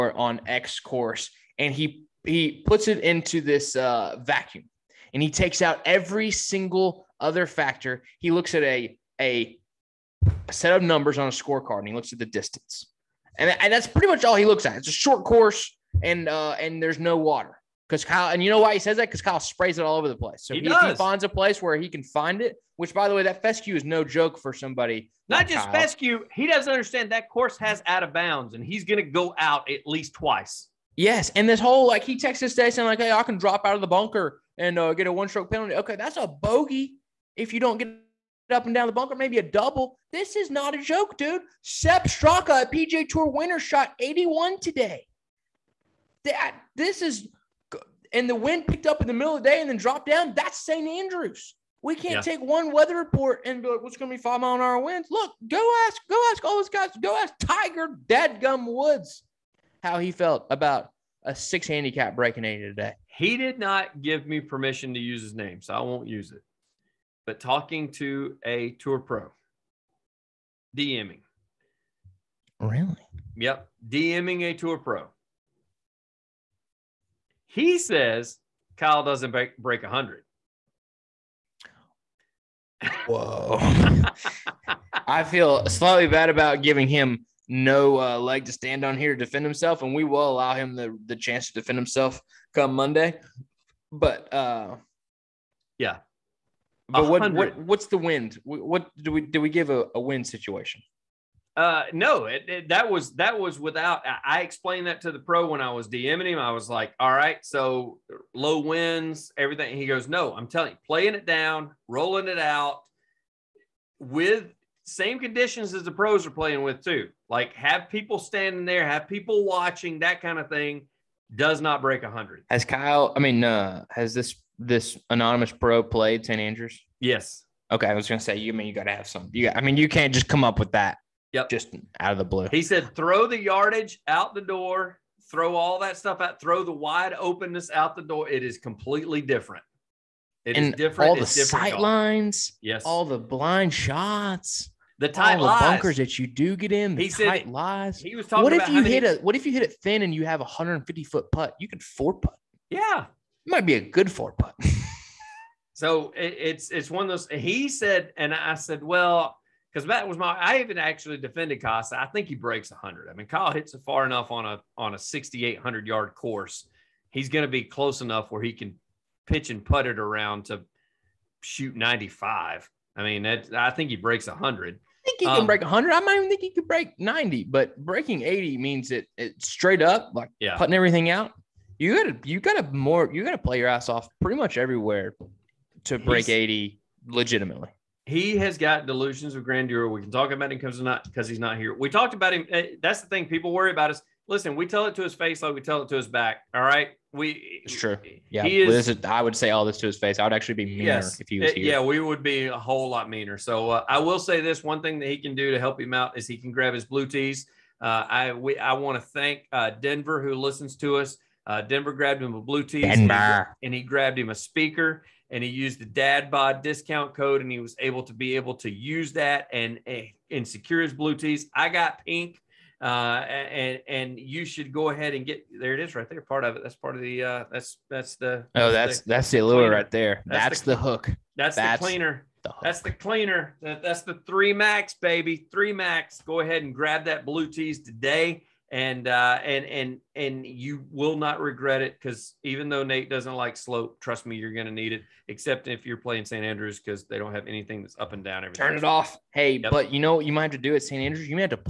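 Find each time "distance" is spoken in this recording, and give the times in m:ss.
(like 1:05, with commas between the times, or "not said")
0:12.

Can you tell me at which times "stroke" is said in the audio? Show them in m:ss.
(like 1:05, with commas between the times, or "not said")
0:35.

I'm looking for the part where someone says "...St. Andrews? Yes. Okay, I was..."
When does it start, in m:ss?
2:06.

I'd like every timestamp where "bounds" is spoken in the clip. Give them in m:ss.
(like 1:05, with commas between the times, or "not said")
0:28.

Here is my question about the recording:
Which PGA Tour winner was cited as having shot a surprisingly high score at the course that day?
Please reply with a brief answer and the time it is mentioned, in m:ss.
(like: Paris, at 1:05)
Sepp Straka, at 0:41.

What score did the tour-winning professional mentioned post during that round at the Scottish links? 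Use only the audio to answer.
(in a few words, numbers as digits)
81.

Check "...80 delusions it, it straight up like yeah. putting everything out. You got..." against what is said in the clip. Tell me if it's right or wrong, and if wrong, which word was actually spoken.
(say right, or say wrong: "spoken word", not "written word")
wrong: "means", not "delusions".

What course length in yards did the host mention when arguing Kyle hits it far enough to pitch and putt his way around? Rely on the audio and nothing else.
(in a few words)
6800.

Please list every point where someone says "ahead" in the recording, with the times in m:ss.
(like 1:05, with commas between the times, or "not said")
3:44, 3:56.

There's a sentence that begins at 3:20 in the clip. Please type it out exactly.
I would actually be meaner yes, if he eh, was here.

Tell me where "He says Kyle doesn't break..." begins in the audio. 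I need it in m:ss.
1:17.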